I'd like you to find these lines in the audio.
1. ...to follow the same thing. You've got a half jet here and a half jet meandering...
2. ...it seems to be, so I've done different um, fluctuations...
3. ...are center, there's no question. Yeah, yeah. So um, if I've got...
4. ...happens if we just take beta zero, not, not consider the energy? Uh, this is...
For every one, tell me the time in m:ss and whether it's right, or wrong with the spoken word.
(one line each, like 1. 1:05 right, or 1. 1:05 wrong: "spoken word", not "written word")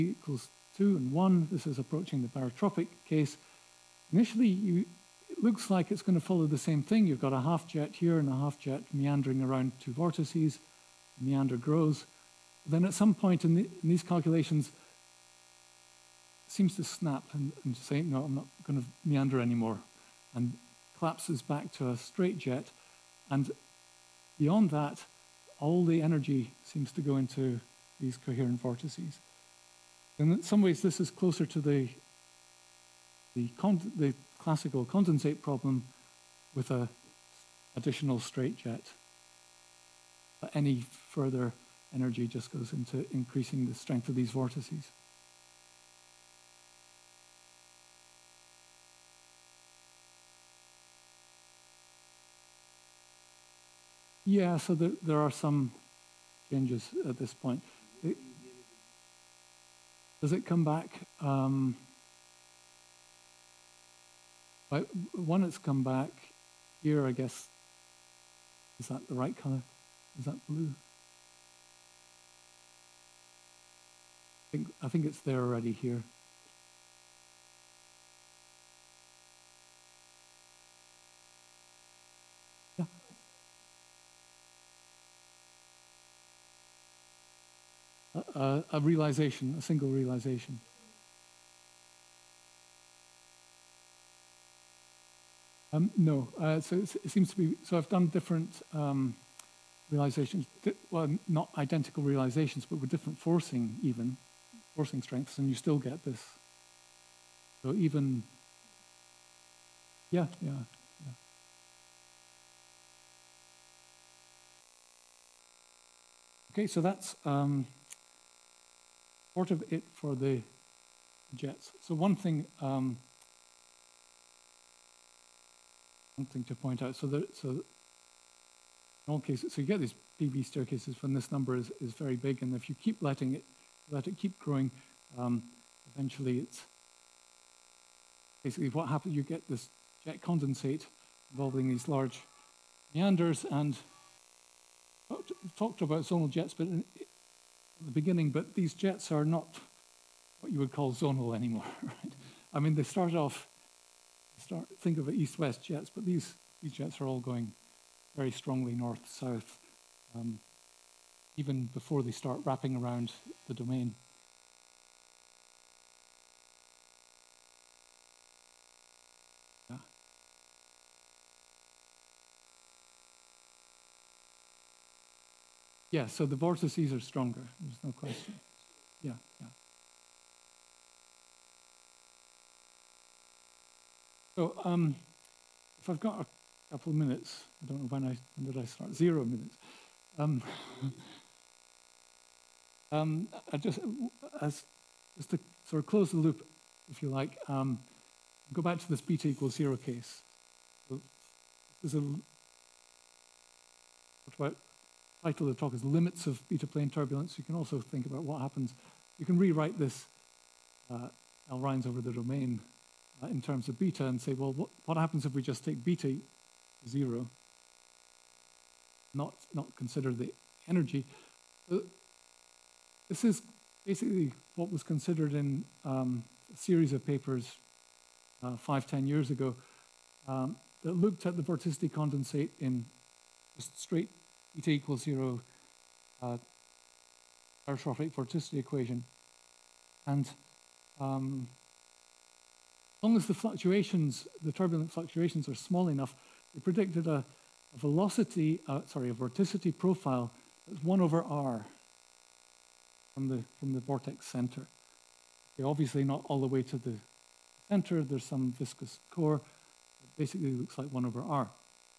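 1. 0:06 right
2. 1:37 wrong: "realizations", not "fluctuations"
3. 2:56 wrong: "stronger", not "center"
4. 3:34 right.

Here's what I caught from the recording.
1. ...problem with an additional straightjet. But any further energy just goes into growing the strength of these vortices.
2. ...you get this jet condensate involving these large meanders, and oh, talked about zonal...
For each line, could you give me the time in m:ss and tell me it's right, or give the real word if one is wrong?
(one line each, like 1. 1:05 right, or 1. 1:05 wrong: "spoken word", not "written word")
1. 0:35 wrong: "increasing", not "growing"
2. 2:19 right.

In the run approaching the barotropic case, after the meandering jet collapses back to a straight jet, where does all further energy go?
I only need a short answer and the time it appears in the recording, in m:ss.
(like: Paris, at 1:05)
Coherent vortices, at 0:28.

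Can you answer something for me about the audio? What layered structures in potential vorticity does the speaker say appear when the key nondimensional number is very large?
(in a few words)
PV staircases.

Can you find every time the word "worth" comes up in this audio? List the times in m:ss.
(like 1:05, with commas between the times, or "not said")
not said.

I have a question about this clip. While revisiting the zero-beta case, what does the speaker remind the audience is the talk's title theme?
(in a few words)
Limits of beta plane turbulence.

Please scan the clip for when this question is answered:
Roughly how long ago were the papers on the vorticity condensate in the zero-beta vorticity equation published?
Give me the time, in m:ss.
3:48.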